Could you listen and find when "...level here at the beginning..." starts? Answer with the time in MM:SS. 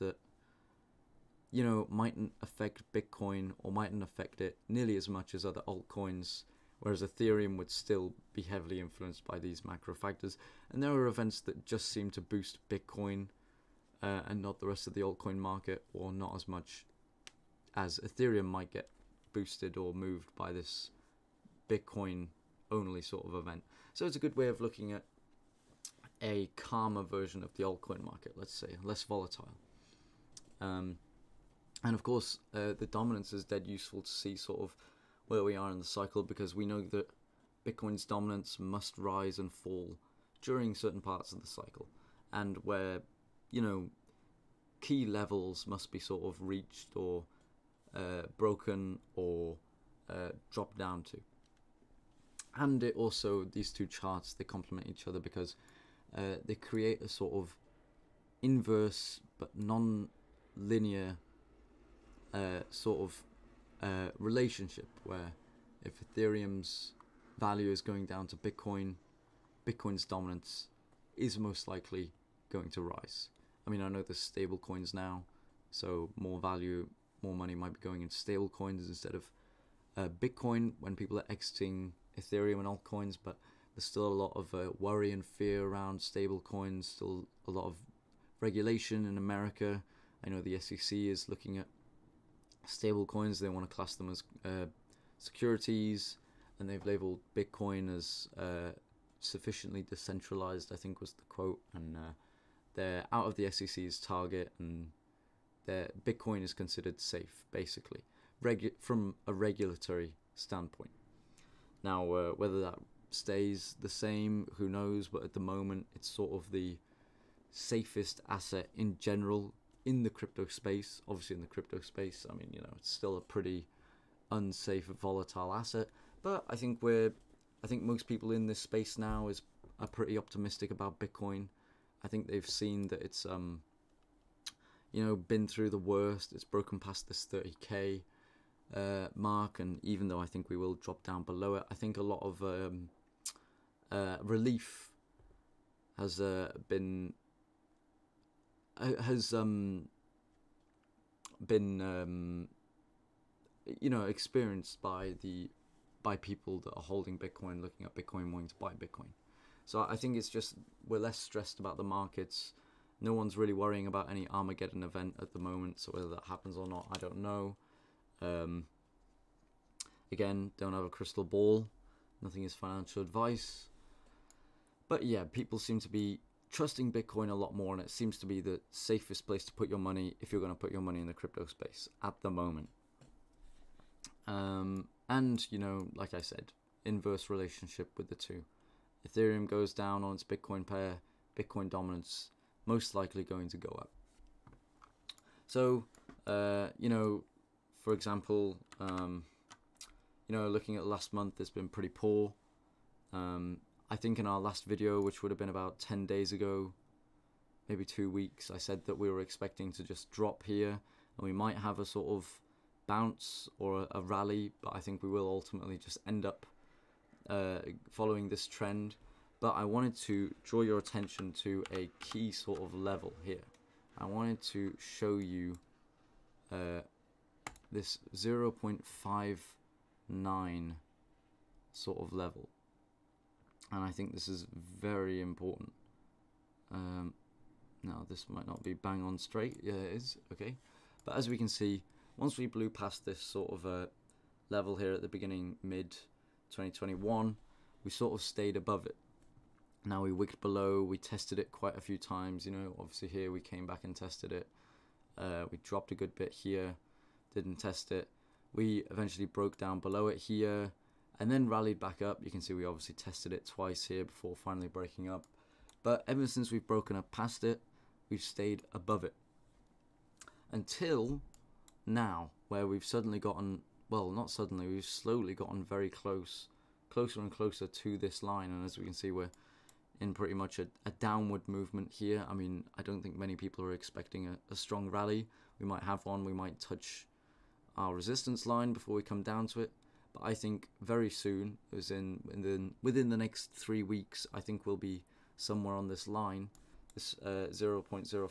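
04:04.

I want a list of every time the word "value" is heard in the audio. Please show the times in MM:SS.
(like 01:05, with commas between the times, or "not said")
01:07, 01:16.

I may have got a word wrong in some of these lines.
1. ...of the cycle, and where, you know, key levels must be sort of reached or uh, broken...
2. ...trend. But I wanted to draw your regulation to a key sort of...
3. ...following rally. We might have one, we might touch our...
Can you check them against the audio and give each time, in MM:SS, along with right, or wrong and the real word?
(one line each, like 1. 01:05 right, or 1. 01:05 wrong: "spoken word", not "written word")
1. 00:41 right
2. 03:38 wrong: "attention", not "regulation"
3. 04:44 wrong: "strong", not "following".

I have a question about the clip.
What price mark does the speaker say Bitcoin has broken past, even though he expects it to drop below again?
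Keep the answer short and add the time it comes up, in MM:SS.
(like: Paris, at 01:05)
30k, at 02:17.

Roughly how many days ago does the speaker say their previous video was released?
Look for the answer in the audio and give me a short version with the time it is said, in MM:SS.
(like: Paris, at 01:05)
10 days, at 03:25.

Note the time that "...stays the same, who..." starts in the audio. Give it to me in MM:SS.
01:53.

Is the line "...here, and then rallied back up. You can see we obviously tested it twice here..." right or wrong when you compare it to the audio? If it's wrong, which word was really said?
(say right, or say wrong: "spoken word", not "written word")
right.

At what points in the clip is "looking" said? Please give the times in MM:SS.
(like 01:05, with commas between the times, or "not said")
00:24, 01:31, 02:37, 03:20.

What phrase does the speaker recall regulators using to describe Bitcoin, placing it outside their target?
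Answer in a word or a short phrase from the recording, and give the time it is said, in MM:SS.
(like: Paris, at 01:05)
sufficiently decentralized, at 01:39.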